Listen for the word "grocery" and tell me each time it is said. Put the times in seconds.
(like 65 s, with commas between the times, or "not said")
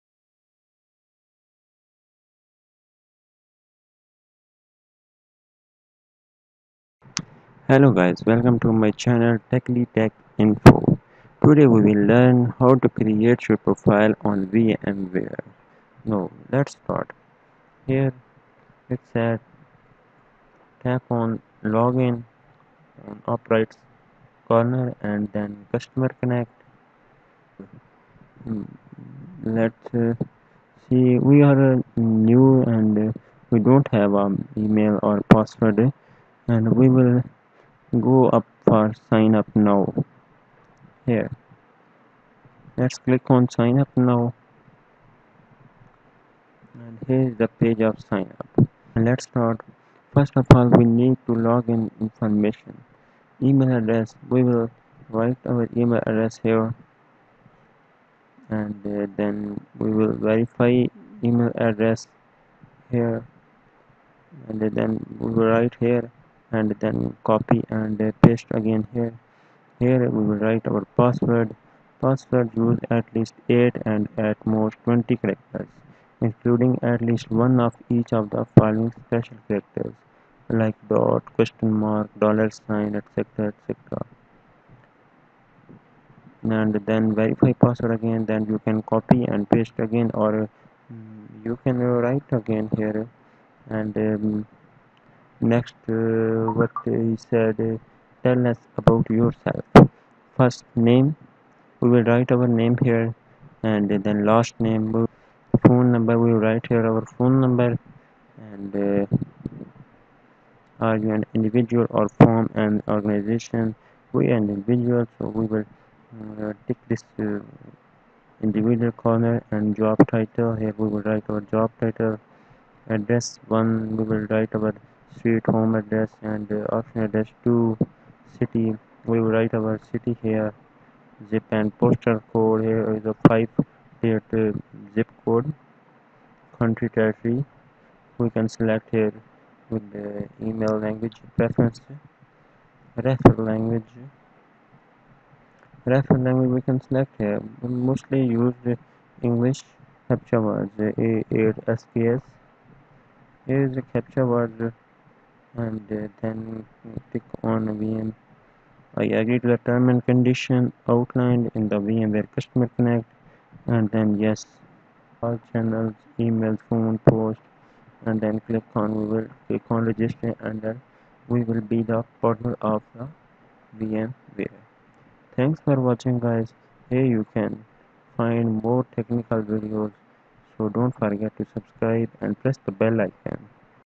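not said.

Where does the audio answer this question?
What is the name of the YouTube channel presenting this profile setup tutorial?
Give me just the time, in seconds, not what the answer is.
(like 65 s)
9 s.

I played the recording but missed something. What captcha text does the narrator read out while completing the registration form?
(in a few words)
a8sps.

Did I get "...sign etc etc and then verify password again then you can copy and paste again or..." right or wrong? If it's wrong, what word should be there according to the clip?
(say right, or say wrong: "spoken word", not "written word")
right.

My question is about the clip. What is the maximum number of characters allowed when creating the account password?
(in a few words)
20.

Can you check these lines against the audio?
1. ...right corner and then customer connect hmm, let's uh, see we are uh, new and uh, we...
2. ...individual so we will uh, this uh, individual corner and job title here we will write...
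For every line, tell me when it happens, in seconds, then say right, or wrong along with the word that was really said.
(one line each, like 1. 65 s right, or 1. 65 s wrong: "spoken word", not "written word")
1. 23 s right
2. 114 s right.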